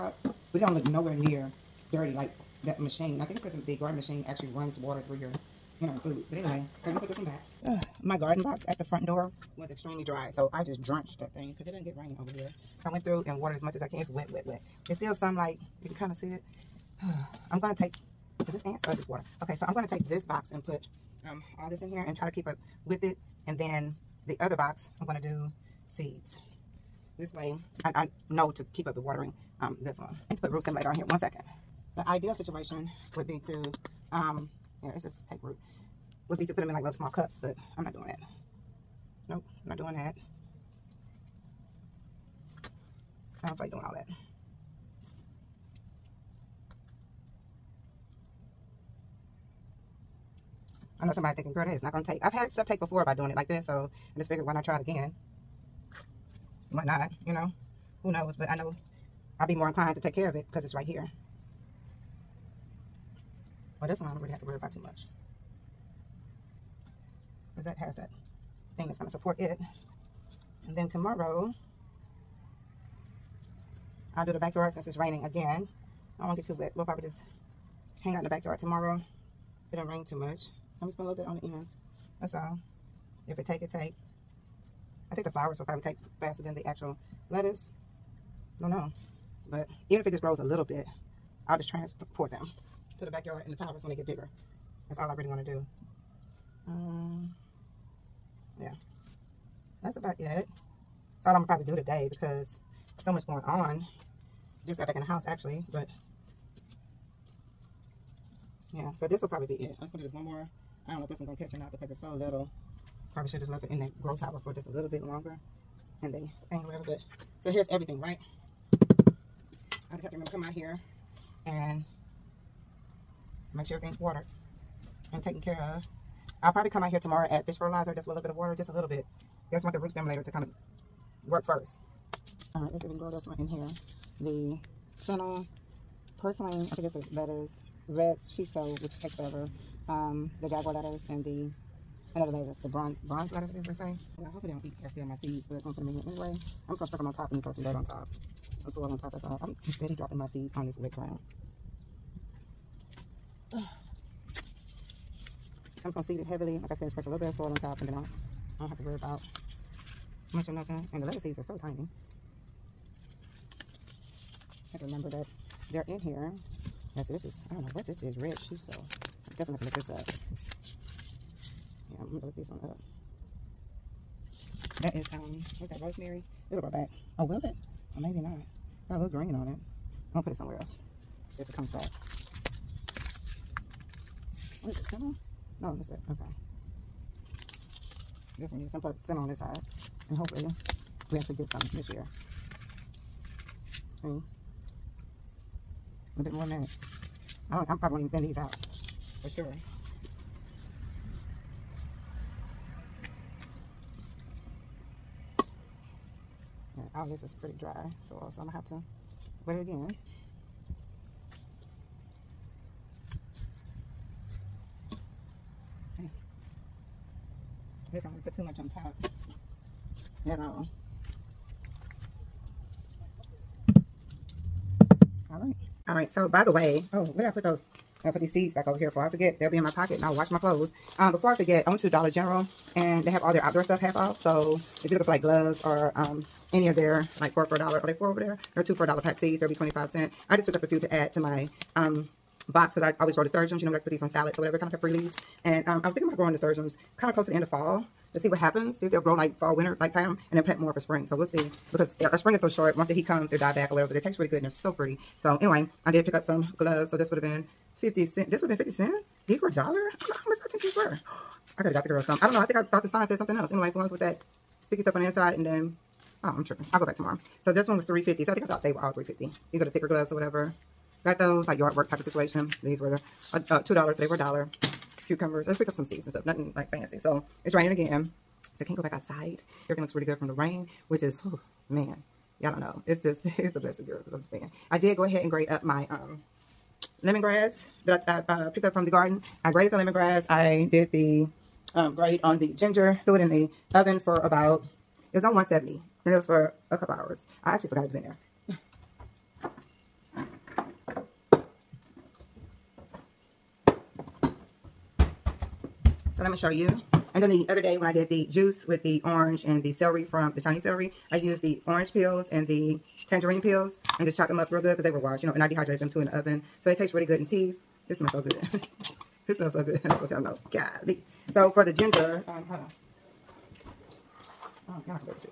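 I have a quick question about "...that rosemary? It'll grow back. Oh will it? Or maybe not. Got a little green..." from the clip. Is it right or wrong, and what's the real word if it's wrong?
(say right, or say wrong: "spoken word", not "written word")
right.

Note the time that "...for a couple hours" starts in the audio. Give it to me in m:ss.
4:56.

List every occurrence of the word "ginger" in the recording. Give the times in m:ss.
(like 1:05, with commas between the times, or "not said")
4:52, 5:21.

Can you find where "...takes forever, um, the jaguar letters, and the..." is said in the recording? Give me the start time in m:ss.
2:19.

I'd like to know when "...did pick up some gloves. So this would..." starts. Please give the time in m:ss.
4:15.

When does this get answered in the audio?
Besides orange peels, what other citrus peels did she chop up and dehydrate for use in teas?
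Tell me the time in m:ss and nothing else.
5:13.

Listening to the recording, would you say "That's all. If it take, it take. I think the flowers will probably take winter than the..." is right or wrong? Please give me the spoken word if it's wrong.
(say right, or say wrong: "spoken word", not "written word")
wrong: "faster", not "winter".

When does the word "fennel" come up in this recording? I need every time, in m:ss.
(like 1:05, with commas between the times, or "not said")
2:15, 3:04.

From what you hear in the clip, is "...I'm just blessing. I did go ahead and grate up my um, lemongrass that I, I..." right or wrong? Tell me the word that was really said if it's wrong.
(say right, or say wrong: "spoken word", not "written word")
wrong: "saying", not "blessing".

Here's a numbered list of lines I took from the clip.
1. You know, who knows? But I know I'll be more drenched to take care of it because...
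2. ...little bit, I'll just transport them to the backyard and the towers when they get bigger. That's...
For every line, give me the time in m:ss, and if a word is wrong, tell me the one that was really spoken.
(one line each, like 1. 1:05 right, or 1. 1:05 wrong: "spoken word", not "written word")
1. 0:57 wrong: "inclined", not "drenched"
2. 1:30 right.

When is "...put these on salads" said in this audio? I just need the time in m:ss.
4:03.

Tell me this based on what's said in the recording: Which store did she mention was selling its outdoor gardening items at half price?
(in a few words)
Dollar General.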